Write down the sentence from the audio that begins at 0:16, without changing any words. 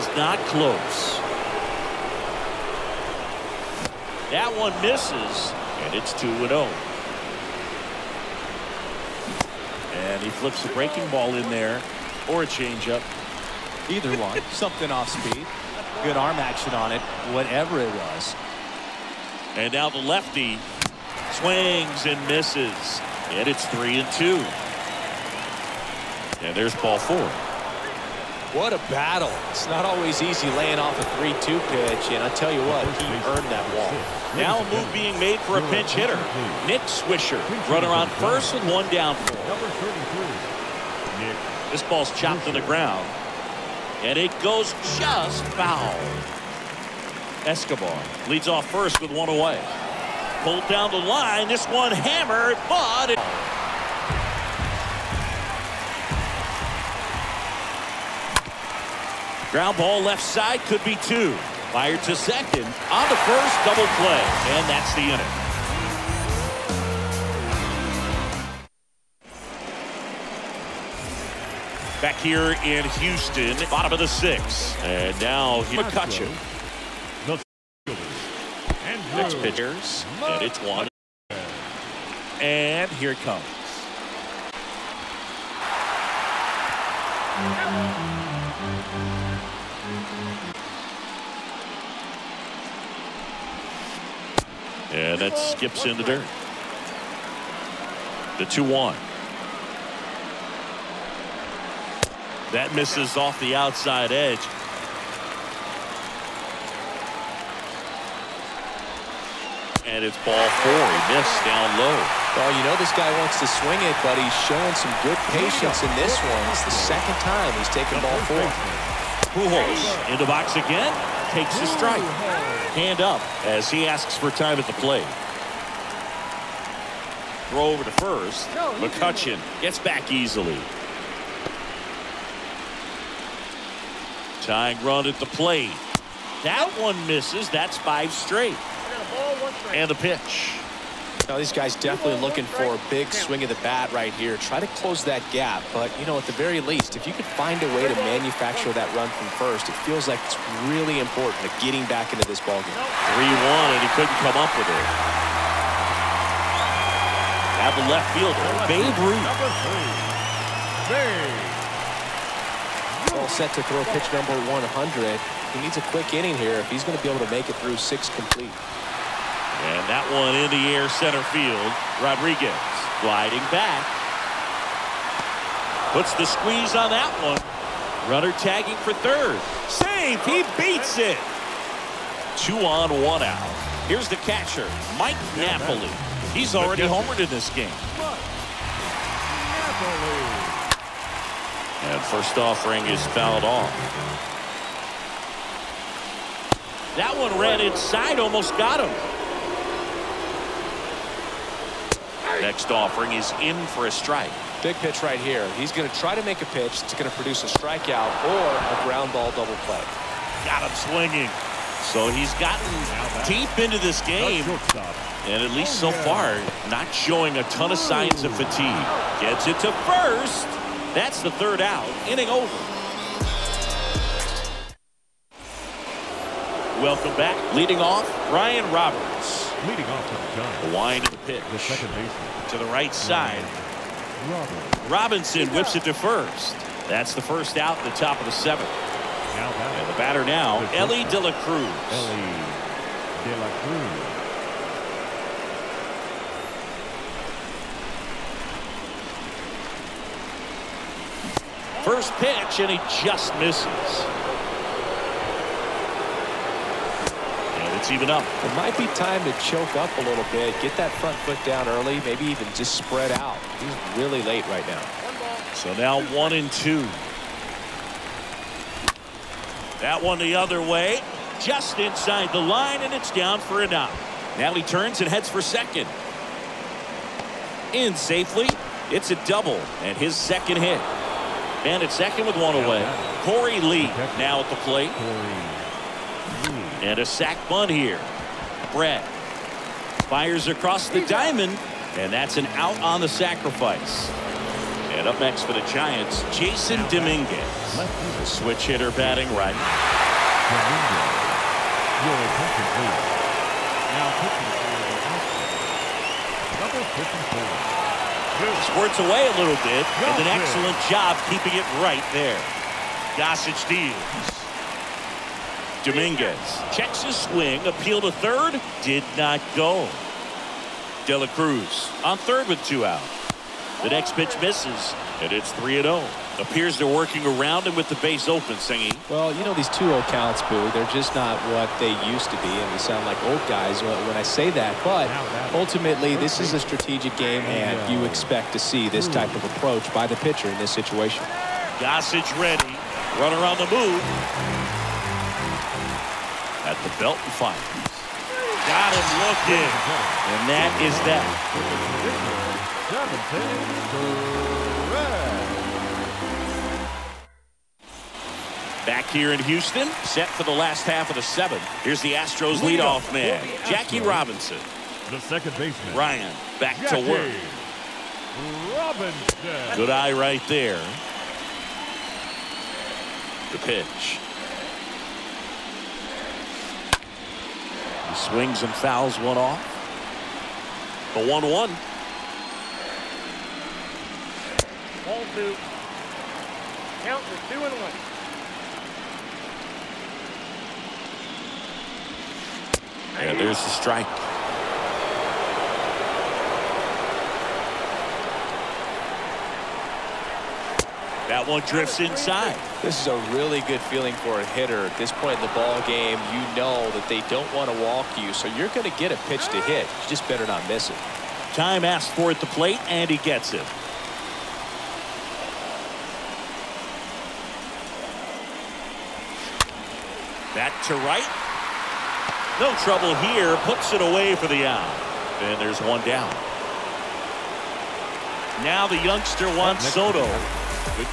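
Good arm action on it, whatever it was.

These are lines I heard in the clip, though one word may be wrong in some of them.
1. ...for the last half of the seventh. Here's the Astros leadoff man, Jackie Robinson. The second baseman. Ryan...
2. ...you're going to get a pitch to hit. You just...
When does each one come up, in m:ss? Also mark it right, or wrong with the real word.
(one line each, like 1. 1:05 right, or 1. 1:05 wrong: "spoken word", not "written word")
1. 6:00 right
2. 6:48 right.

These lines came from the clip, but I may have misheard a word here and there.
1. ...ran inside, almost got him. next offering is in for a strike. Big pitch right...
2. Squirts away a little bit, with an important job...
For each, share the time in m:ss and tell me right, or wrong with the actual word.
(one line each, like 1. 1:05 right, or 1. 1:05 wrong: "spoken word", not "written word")
1. 3:17 right
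2. 5:08 wrong: "excellent", not "important".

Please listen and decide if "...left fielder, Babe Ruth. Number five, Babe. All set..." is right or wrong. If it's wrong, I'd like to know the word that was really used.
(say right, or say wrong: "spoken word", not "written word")
wrong: "three", not "five".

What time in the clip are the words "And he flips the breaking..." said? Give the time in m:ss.
0:09.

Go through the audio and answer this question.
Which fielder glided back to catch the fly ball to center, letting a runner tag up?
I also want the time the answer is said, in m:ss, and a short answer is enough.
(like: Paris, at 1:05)
Rodriguez, at 2:52.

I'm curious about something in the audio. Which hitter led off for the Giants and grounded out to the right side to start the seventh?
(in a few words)
Ryan Roberts.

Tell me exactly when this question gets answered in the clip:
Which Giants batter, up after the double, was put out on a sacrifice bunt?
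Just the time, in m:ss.
4:43.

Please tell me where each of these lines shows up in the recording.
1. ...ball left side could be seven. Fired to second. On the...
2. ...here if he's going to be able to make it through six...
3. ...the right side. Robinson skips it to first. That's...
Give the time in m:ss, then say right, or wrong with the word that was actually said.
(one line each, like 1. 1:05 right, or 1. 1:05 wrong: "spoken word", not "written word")
1. 0:59 wrong: "two", not "seven"
2. 2:46 right
3. 3:52 wrong: "whips", not "skips".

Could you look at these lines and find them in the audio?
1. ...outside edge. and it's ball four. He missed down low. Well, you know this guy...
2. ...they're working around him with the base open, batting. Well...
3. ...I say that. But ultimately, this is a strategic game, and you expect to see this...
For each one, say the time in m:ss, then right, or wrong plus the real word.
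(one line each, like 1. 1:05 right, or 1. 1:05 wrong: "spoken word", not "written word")
1. 1:43 right
2. 5:26 wrong: "singing", not "batting"
3. 5:34 right.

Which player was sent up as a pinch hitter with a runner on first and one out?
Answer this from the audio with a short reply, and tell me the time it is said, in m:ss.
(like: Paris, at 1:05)
Nick Swisher, at 0:36.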